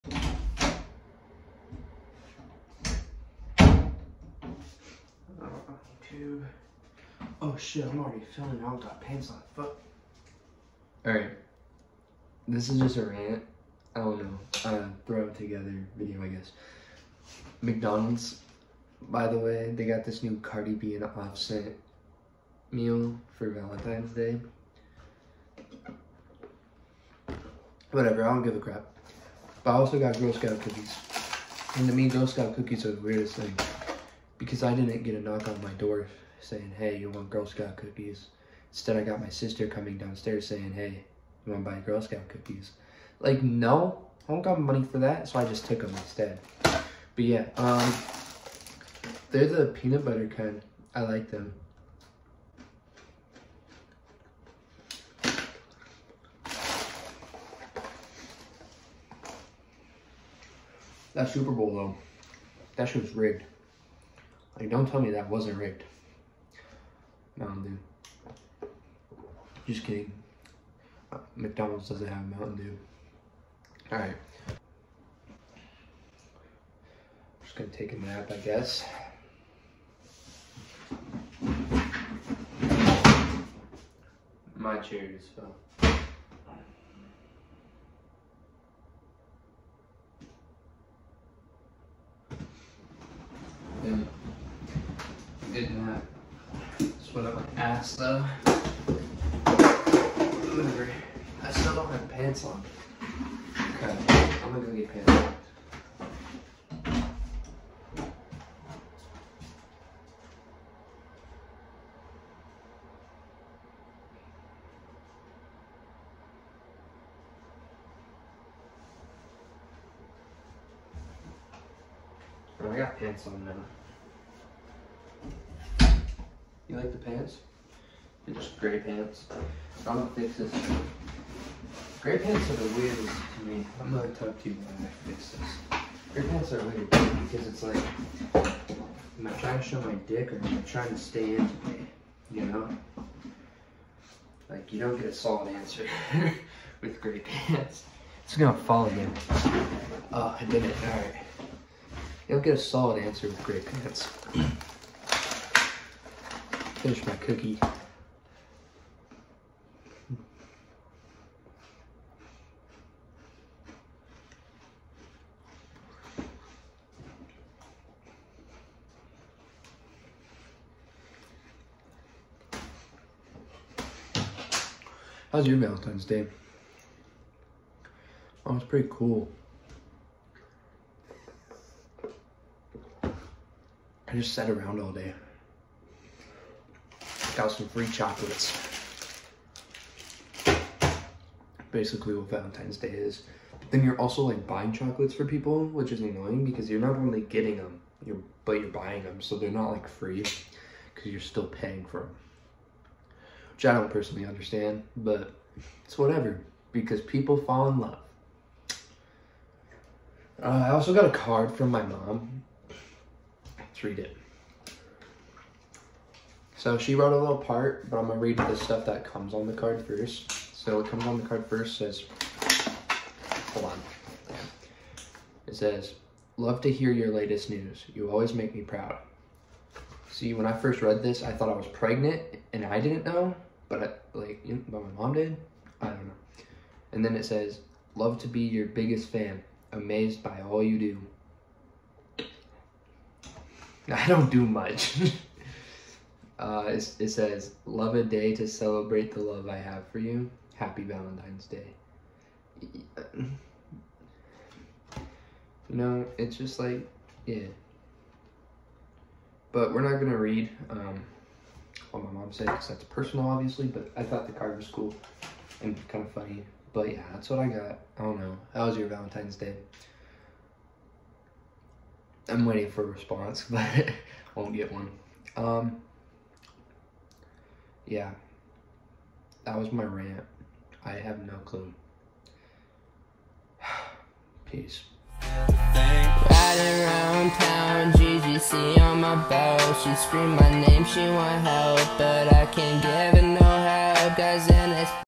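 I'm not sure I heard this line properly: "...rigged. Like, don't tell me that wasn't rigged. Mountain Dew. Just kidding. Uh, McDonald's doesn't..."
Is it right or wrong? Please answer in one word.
right.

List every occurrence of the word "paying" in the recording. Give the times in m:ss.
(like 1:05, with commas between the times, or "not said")
3:21.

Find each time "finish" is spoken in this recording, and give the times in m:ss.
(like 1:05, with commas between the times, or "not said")
2:36.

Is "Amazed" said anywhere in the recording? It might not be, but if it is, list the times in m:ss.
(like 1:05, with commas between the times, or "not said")
3:59.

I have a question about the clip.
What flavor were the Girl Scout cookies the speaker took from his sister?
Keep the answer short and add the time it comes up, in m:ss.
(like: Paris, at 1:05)
Peanut butter, at 0:49.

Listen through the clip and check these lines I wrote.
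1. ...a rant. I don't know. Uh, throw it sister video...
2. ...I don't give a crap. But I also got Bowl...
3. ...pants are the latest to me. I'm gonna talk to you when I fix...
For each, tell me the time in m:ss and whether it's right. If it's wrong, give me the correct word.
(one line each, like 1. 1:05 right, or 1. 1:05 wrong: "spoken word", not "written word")
1. 0:12 wrong: "together", not "sister"
2. 0:28 wrong: "Girl", not "Bowl"
3. 2:12 wrong: "weirdest", not "latest".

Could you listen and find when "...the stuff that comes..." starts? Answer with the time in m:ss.
3:38.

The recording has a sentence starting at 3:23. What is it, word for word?
Which I don't personally understand, but it's whatever because people fall in love.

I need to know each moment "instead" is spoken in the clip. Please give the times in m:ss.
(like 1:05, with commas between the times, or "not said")
0:38, 0:45.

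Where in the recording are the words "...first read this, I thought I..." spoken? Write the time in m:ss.
3:50.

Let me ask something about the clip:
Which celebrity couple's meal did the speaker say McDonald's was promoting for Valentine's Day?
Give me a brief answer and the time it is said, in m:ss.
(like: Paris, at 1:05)
Cardi B and Offset, at 0:20.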